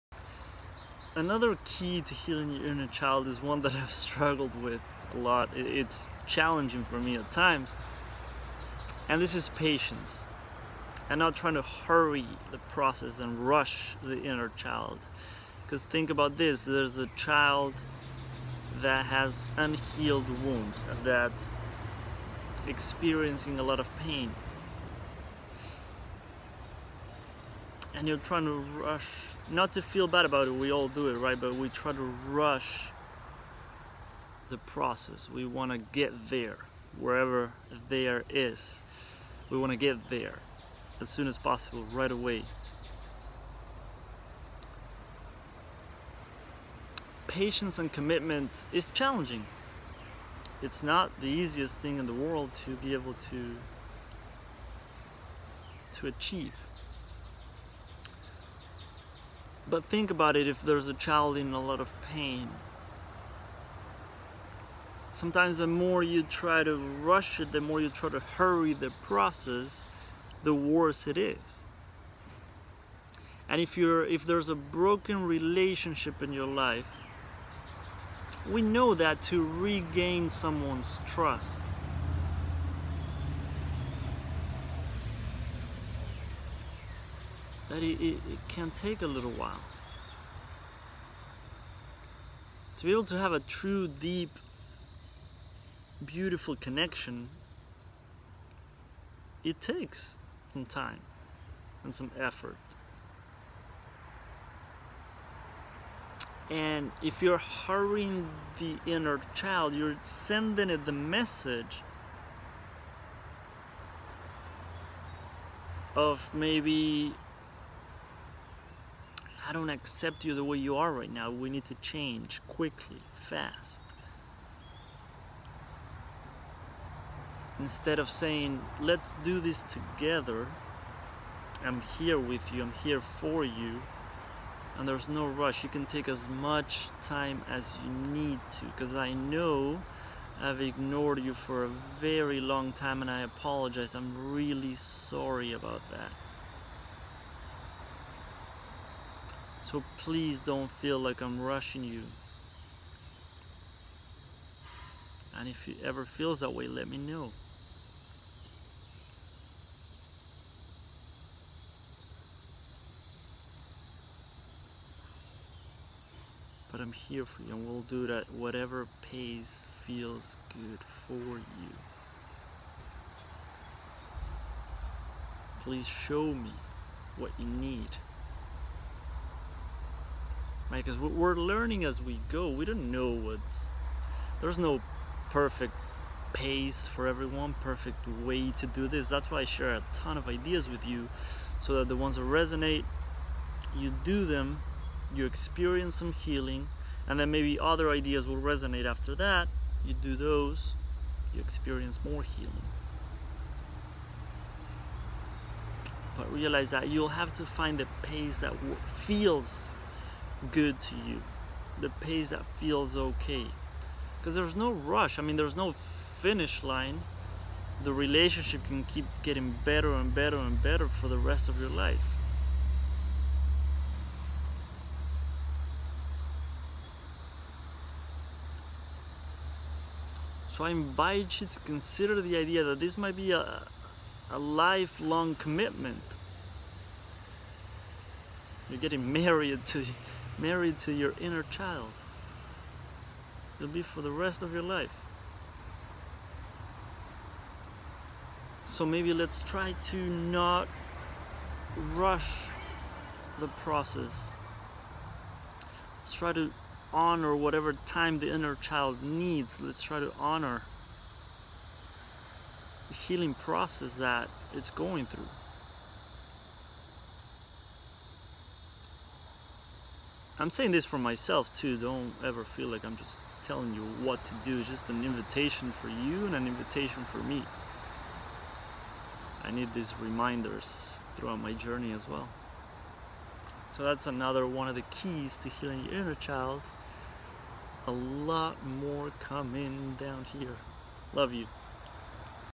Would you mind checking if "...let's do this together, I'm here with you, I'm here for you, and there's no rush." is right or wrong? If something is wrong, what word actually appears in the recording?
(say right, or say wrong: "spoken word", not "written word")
right.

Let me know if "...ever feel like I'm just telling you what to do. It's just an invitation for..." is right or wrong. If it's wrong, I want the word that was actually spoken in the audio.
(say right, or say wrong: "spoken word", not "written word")
right.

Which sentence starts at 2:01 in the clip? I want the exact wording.
We need to change quickly, fast.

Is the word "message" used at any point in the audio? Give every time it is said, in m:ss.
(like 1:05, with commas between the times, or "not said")
1:50.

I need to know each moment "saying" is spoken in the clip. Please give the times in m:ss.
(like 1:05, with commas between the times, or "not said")
2:08, 4:30.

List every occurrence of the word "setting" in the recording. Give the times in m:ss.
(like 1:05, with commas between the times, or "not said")
not said.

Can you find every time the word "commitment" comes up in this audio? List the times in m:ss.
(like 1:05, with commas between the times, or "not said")
0:47, 3:55.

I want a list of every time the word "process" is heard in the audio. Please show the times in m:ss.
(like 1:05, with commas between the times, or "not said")
0:12, 0:34, 1:09, 4:13, 4:23.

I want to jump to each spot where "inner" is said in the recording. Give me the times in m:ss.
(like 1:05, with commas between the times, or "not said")
0:02, 0:14, 1:48, 4:01, 4:18, 4:46.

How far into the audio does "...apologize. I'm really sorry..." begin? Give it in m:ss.
2:23.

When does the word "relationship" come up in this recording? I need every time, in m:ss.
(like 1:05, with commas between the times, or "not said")
1:15, 3:37.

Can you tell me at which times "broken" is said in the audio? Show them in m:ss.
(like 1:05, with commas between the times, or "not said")
1:14.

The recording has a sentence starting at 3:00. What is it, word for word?
Because we're learning as we go.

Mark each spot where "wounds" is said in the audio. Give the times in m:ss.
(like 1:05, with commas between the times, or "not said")
0:20.